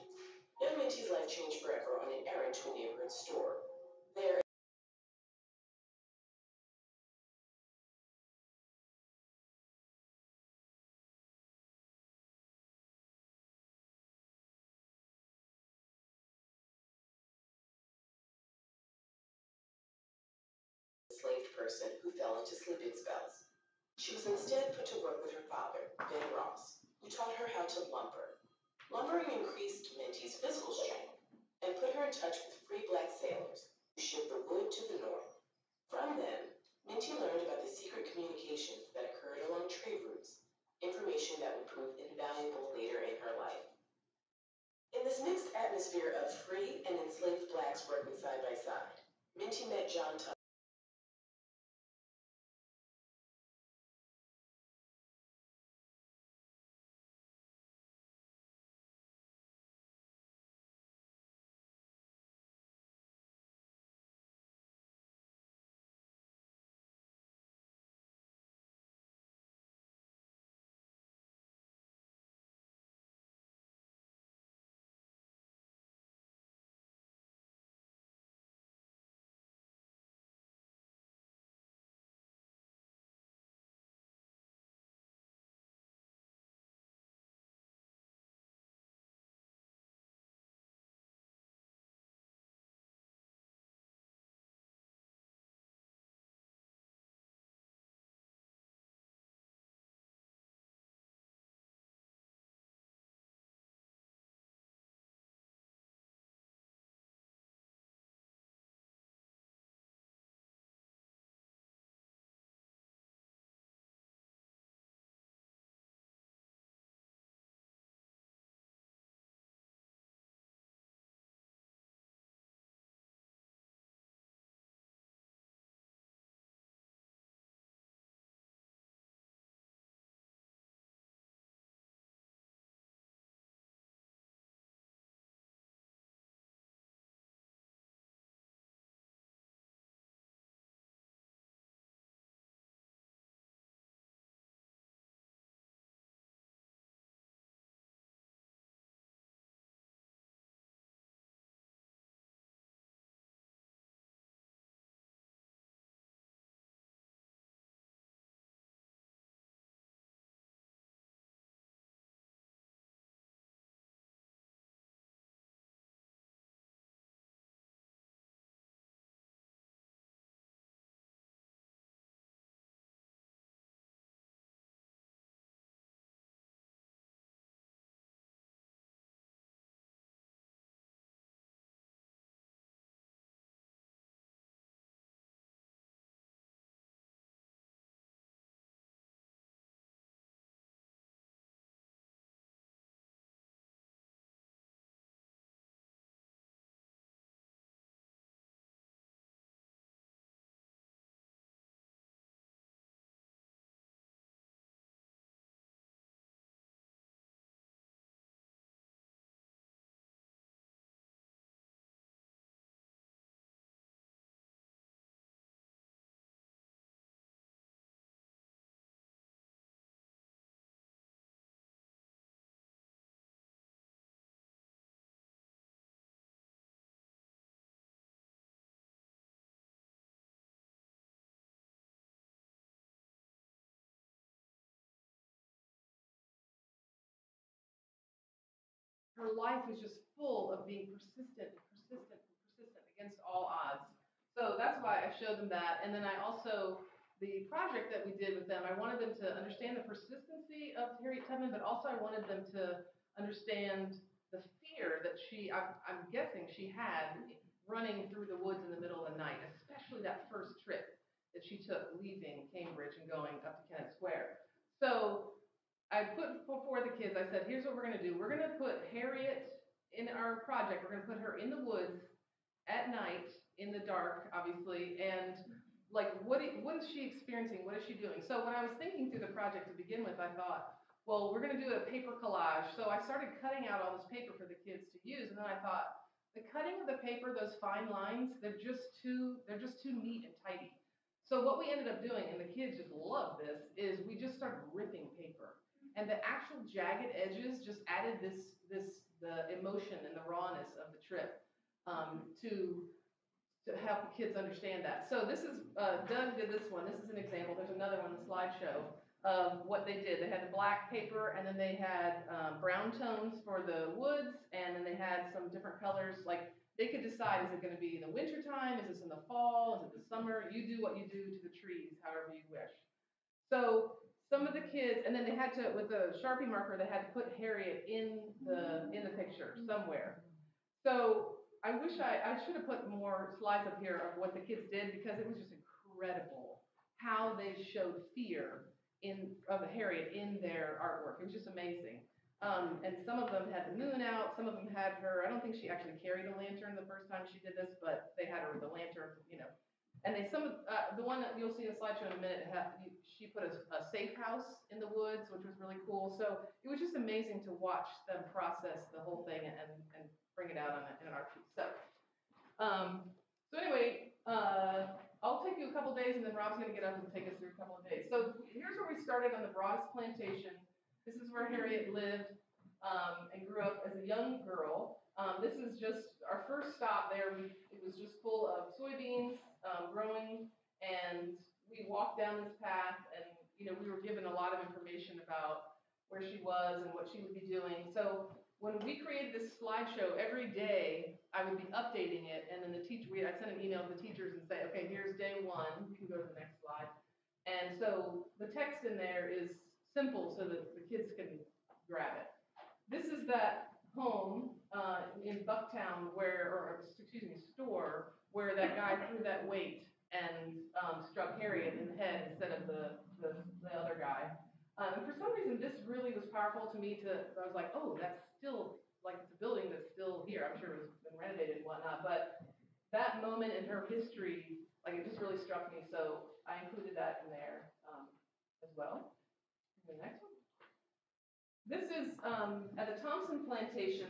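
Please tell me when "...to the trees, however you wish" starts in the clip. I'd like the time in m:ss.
5:21.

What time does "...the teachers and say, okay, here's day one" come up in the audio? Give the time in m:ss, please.
6:33.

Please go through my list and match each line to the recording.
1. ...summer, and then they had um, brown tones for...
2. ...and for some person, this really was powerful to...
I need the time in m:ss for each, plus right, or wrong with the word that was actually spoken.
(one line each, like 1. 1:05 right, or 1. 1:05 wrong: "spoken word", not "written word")
1. 5:10 wrong: "paper", not "summer"
2. 6:54 wrong: "reason", not "person".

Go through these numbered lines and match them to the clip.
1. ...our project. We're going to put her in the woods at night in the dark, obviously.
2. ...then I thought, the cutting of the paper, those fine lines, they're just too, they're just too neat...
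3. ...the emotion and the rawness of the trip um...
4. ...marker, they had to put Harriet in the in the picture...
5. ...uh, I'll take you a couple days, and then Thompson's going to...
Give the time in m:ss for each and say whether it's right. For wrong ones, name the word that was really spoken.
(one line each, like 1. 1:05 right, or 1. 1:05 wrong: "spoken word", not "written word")
1. 4:30 right
2. 4:45 right
3. 4:59 right
4. 5:26 right
5. 6:04 wrong: "Rob", not "Thompson".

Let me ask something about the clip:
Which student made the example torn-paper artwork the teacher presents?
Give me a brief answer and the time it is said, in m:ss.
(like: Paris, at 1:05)
Doug, at 5:06.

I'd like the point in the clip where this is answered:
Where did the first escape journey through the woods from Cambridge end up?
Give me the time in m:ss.
4:23.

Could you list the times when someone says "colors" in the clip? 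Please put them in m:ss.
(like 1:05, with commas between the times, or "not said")
5:15.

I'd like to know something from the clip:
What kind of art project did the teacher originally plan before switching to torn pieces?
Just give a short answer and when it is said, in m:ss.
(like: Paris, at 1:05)
a paper collage, at 4:41.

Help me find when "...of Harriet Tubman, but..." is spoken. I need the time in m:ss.
4:10.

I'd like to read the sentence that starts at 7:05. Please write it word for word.
So I included that in there um, as well.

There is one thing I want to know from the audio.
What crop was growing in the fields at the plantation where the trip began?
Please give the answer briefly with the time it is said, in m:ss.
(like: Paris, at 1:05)
soybeans, at 6:18.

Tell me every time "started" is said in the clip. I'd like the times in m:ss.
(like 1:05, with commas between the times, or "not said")
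4:43, 4:54, 6:09.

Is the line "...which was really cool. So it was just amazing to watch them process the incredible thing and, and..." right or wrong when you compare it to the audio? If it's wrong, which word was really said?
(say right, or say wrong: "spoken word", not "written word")
wrong: "whole", not "incredible".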